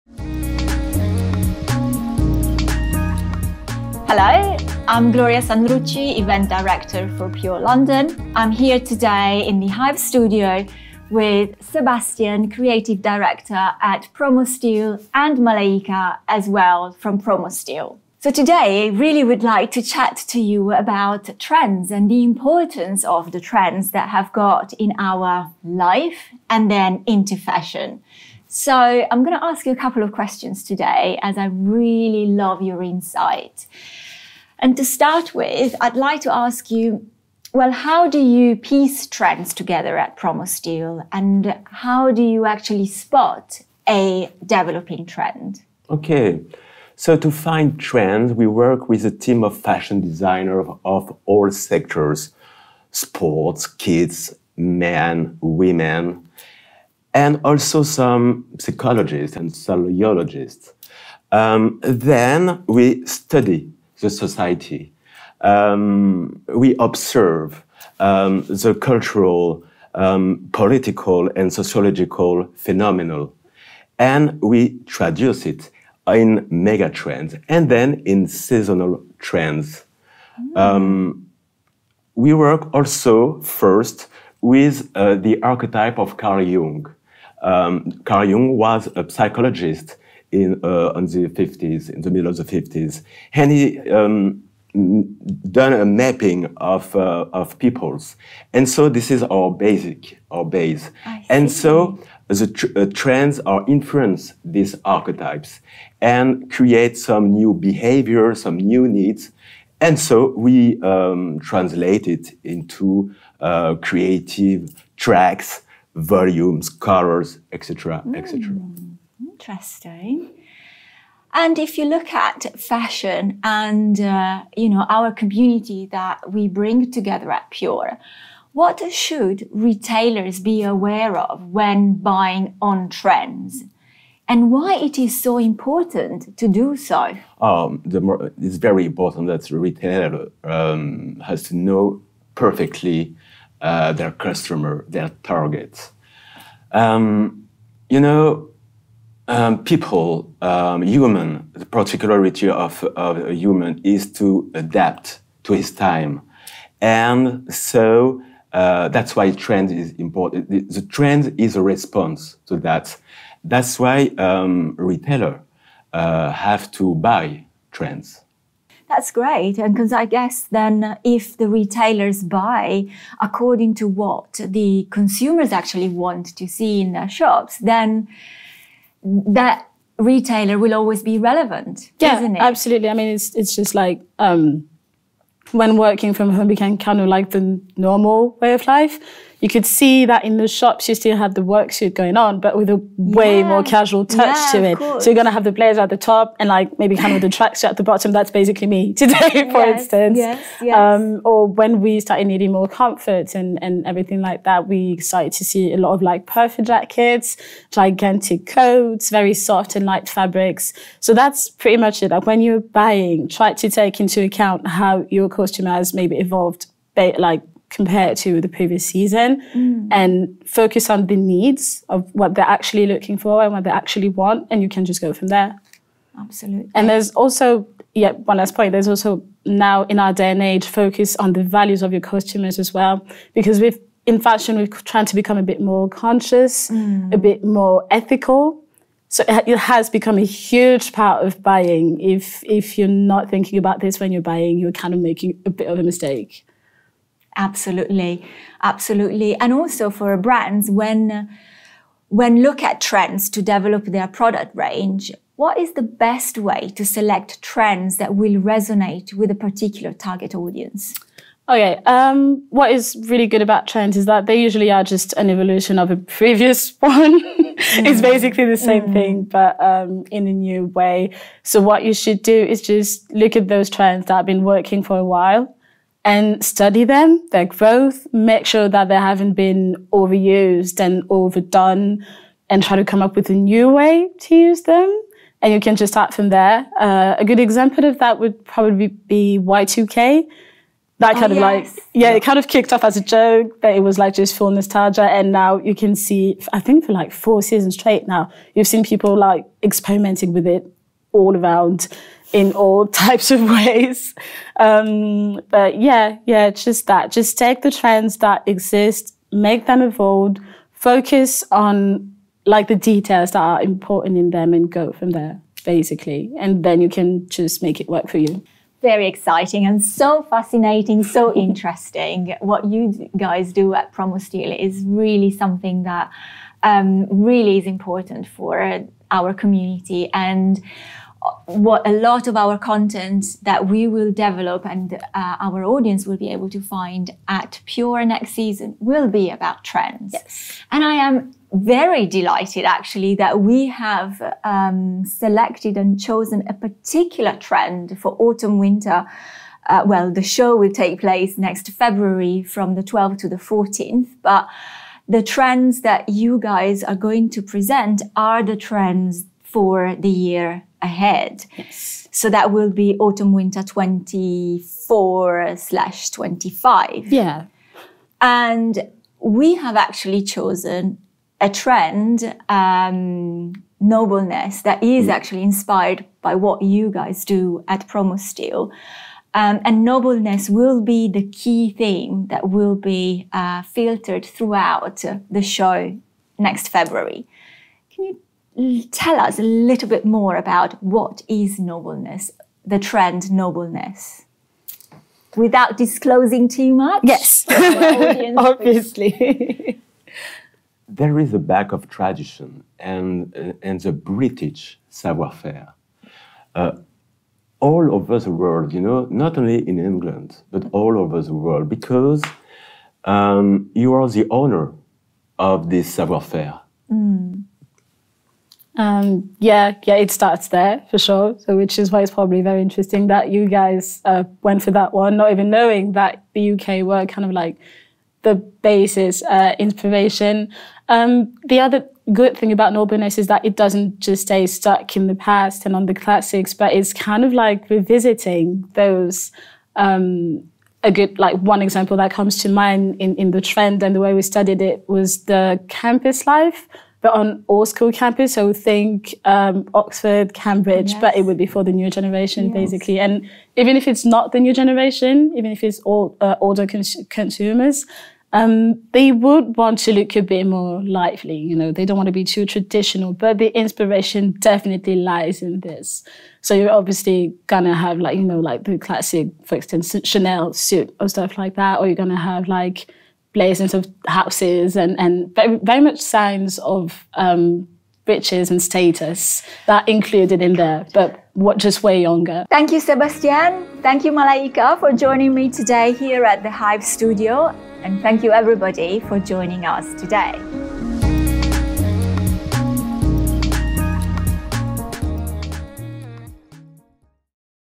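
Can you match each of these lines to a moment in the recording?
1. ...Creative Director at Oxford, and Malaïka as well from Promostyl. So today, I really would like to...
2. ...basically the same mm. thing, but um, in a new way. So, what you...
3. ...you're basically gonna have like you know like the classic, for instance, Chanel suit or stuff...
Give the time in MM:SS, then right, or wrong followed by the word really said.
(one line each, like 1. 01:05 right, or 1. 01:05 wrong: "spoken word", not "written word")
1. 00:12 wrong: "Promostyl", not "Oxford"
2. 04:28 right
3. 07:46 wrong: "obviously", not "basically".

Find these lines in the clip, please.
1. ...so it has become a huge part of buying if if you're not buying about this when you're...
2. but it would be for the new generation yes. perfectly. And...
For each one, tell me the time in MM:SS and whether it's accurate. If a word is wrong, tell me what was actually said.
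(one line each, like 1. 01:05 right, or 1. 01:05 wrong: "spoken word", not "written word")
1. 03:59 wrong: "thinking", not "buying"
2. 07:31 wrong: "basically", not "perfectly".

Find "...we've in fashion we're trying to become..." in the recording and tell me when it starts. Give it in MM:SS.
03:53.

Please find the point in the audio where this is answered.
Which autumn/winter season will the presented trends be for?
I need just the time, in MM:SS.
06:02.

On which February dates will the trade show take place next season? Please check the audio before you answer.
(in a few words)
12th to 14th.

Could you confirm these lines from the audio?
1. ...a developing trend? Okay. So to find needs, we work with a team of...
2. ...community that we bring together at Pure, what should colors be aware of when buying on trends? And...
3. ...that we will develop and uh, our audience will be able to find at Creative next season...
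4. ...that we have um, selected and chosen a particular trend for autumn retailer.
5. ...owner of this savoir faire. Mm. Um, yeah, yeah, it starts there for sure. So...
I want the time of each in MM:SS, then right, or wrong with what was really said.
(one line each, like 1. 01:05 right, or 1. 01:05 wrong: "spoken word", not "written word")
1. 00:43 wrong: "trends", not "needs"
2. 02:05 wrong: "retailers", not "colors"
3. 05:33 wrong: "Pure", not "Creative"
4. 05:43 wrong: "winter", not "retailer"
5. 06:54 right.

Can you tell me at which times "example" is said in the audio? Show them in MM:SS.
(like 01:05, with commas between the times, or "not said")
04:47, 07:21.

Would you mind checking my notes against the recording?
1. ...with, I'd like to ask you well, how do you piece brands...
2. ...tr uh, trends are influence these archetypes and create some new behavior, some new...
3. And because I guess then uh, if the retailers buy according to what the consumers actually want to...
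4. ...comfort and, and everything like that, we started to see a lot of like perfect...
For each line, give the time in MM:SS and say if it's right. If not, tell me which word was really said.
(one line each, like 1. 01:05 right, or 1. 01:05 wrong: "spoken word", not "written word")
1. 00:35 wrong: "trends", not "brands"
2. 01:42 right
3. 02:49 right
4. 03:22 right.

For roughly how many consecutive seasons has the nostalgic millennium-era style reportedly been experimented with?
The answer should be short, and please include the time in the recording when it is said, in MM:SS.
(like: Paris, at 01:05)
4, at 04:57.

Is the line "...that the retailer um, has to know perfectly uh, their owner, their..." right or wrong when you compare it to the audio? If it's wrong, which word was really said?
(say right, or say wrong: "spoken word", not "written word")
wrong: "customer", not "owner".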